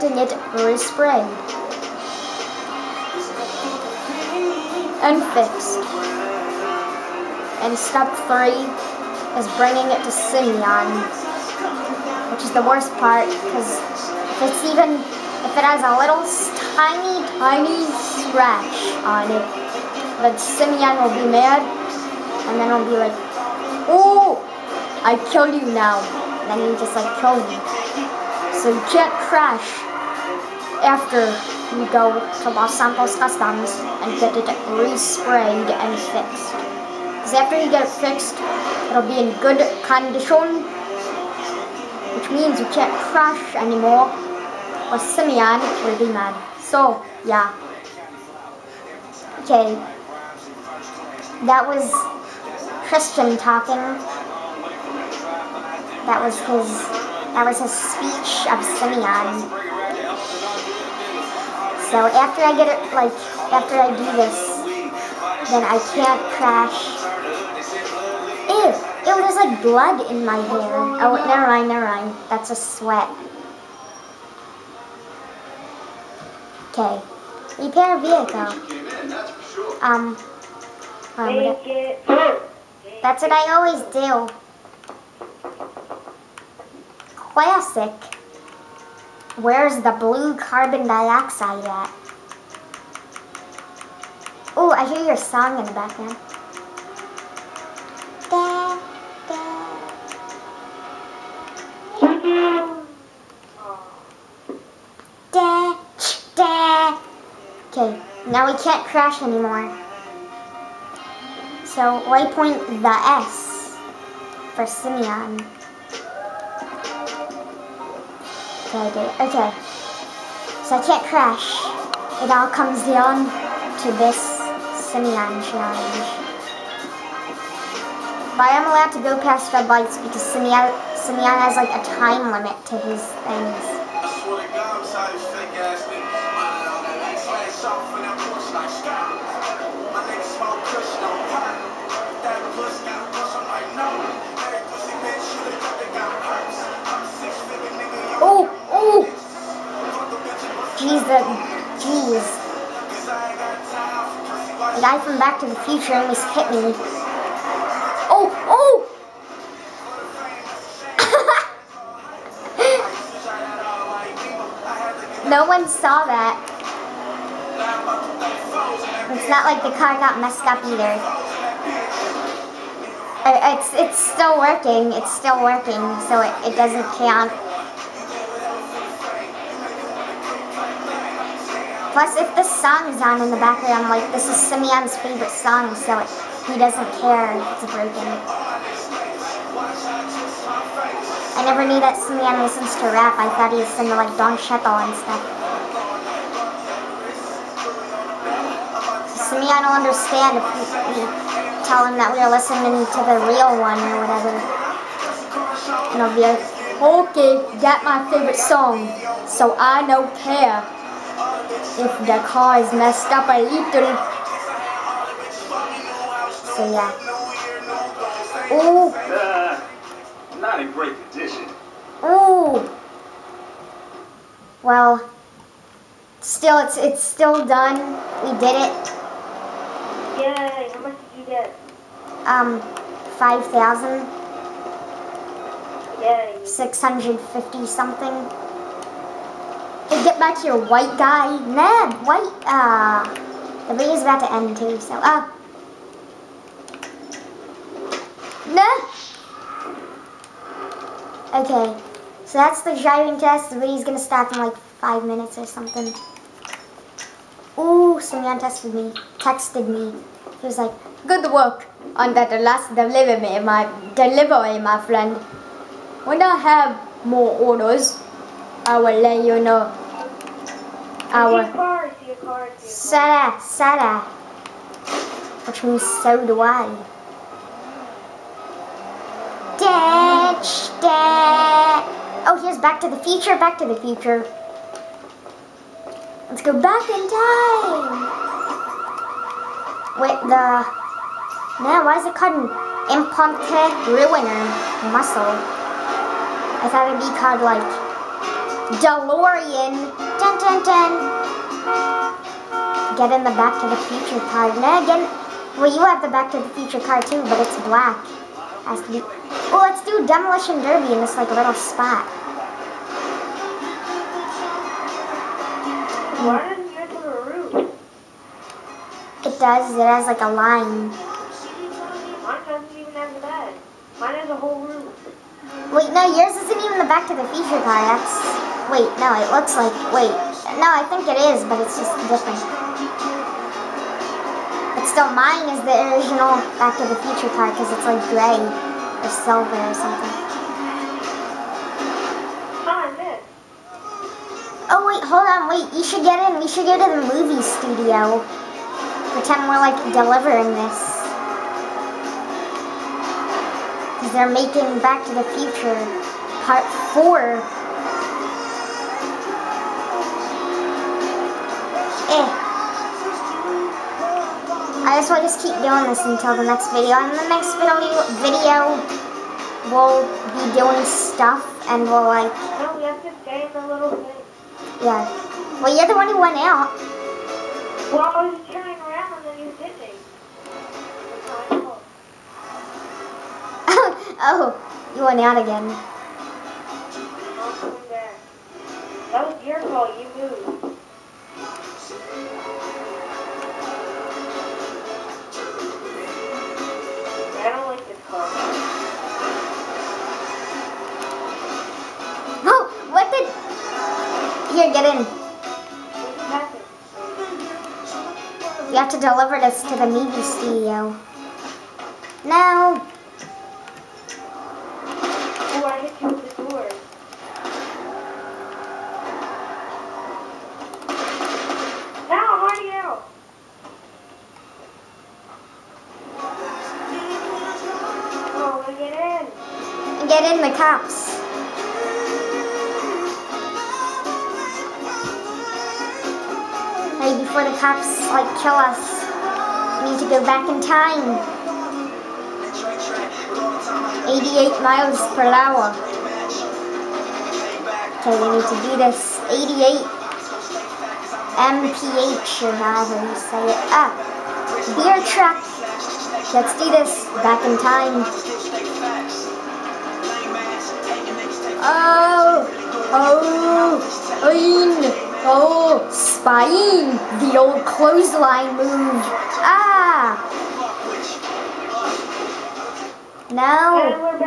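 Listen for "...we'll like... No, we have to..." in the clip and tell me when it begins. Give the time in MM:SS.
06:11.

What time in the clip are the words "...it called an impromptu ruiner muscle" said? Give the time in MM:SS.
04:52.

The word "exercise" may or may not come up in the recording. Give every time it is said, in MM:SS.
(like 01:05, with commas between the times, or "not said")
not said.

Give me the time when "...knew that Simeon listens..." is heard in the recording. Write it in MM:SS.
03:11.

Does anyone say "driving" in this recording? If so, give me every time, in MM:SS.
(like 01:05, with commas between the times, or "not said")
04:12.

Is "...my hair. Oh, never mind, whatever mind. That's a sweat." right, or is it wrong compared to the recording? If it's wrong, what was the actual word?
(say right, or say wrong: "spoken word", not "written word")
wrong: "never", not "whatever".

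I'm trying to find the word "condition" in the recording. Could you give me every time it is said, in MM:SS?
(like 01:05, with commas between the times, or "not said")
00:39, 03:41.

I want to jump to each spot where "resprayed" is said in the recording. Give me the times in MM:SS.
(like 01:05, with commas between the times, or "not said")
00:00, 00:34.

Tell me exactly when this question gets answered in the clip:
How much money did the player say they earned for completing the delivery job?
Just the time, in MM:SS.
03:53.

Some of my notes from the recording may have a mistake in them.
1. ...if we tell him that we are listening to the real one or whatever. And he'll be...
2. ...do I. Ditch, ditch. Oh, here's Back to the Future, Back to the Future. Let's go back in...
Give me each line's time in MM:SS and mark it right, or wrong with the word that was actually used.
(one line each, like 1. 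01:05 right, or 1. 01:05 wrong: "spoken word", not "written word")
1. 03:20 right
2. 04:36 right.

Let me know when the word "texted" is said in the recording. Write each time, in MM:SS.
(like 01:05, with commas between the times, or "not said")
04:19.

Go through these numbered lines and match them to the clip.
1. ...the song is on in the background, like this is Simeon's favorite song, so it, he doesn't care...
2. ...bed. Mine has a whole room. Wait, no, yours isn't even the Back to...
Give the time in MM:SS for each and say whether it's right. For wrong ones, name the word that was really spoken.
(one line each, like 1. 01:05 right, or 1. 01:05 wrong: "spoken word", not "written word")
1. 03:02 right
2. 05:23 right.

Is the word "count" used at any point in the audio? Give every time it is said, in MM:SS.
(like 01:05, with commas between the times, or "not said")
02:56.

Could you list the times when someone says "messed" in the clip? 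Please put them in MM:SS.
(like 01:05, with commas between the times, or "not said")
02:50, 03:32.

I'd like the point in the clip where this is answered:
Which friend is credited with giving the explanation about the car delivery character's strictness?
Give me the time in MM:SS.
00:52.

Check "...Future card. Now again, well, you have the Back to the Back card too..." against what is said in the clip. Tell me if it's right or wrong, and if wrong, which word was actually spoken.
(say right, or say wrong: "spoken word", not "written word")
wrong: "Future", not "Back".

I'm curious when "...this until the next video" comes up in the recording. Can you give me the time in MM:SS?
06:05.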